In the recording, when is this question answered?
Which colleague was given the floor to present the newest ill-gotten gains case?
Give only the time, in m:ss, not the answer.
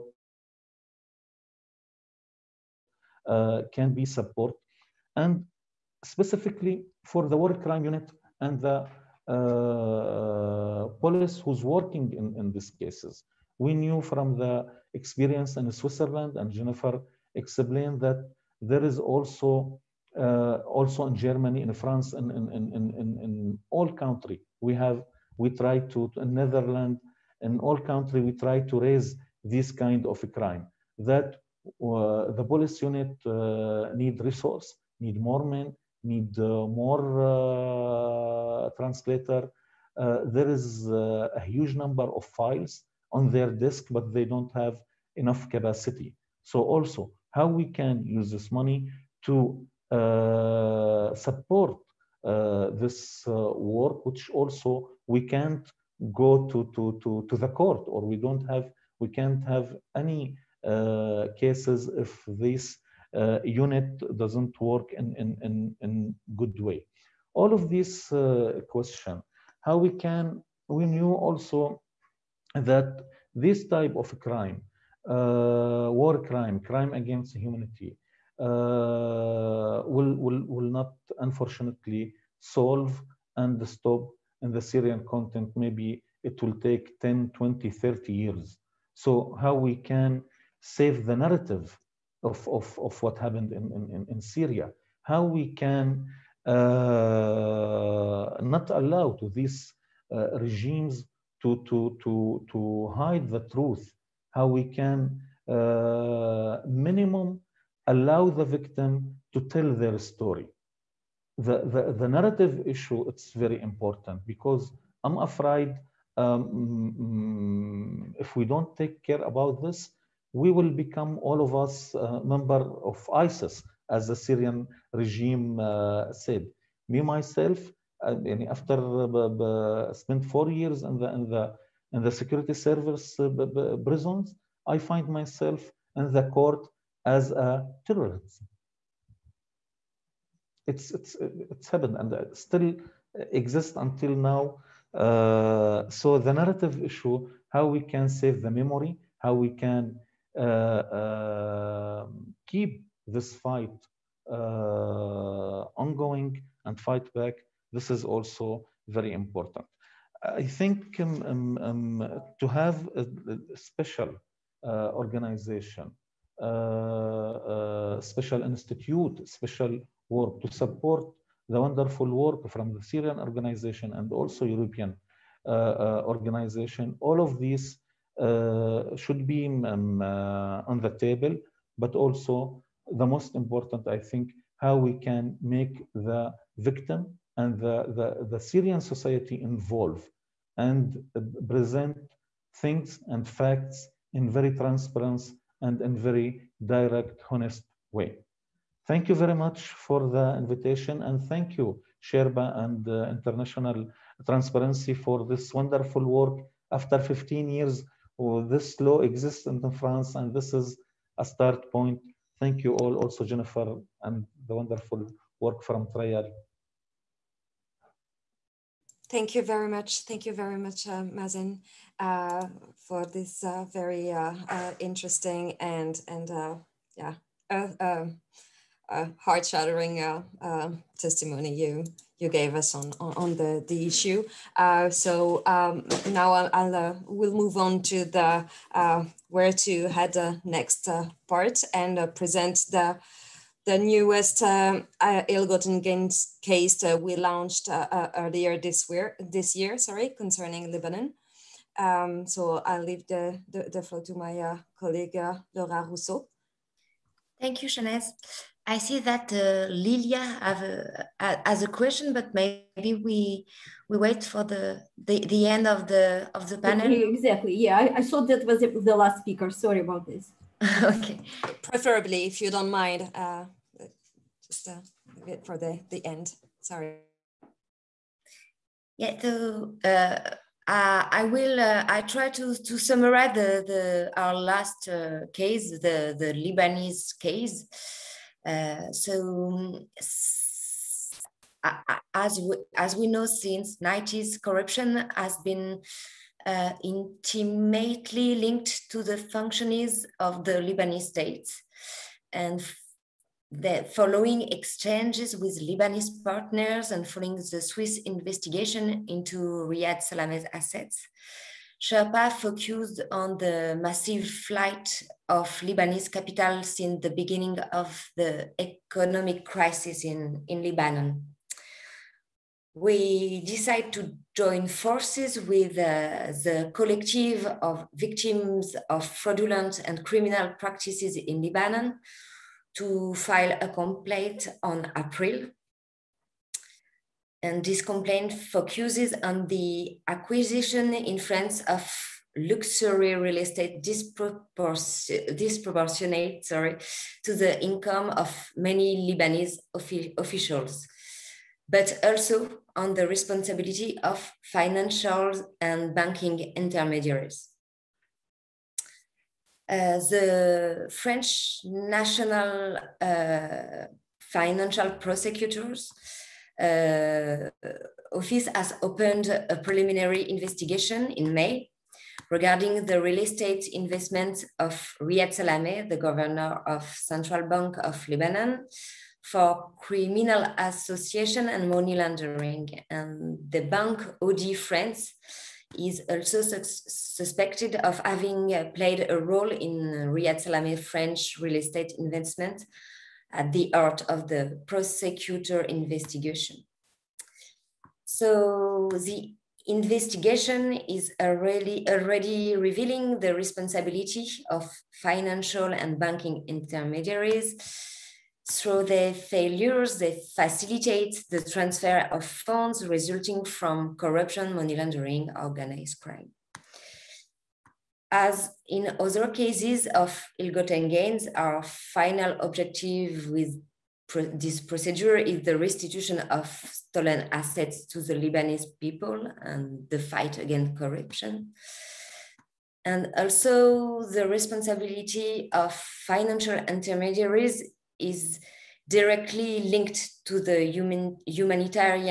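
4:15.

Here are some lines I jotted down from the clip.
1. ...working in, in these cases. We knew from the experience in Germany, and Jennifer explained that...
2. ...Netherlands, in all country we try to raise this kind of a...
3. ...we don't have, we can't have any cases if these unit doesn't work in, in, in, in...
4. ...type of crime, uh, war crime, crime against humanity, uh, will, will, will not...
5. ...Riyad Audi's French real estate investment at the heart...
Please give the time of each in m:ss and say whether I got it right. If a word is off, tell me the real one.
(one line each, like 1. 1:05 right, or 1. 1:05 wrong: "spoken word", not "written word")
1. 0:11 wrong: "Switzerland", not "Germany"
2. 0:26 right
3. 0:58 right
4. 1:13 right
5. 6:30 wrong: "Salameh", not "Audi".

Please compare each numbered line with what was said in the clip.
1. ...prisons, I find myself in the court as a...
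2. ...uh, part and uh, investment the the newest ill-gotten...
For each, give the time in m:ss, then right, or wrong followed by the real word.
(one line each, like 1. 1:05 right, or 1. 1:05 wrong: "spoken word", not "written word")
1. 2:13 right
2. 4:00 wrong: "present", not "investment".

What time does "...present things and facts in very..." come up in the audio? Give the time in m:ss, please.
3:11.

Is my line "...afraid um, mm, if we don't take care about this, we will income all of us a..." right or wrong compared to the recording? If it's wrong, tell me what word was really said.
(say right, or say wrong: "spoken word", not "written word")
wrong: "become", not "income".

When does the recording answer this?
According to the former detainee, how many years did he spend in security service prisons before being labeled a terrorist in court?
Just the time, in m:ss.
2:10.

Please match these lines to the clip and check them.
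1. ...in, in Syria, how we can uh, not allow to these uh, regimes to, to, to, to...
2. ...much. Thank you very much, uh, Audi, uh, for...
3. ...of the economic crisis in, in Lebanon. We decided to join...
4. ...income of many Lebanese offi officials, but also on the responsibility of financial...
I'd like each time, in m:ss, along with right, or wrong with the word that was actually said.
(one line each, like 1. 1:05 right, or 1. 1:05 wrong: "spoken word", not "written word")
1. 1:33 right
2. 3:39 wrong: "Mazen", not "Audi"
3. 5:17 right
4. 5:47 right.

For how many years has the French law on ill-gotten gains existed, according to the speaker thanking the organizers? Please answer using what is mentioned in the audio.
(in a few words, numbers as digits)
15.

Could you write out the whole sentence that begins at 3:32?
Thank you all, also Jennifer and the wonderful work from Trial.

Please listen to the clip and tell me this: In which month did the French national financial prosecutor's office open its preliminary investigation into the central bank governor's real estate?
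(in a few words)
May.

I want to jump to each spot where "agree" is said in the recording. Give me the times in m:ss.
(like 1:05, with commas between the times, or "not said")
not said.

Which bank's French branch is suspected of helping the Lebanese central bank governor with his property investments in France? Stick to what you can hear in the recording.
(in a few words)
Bank Audi France.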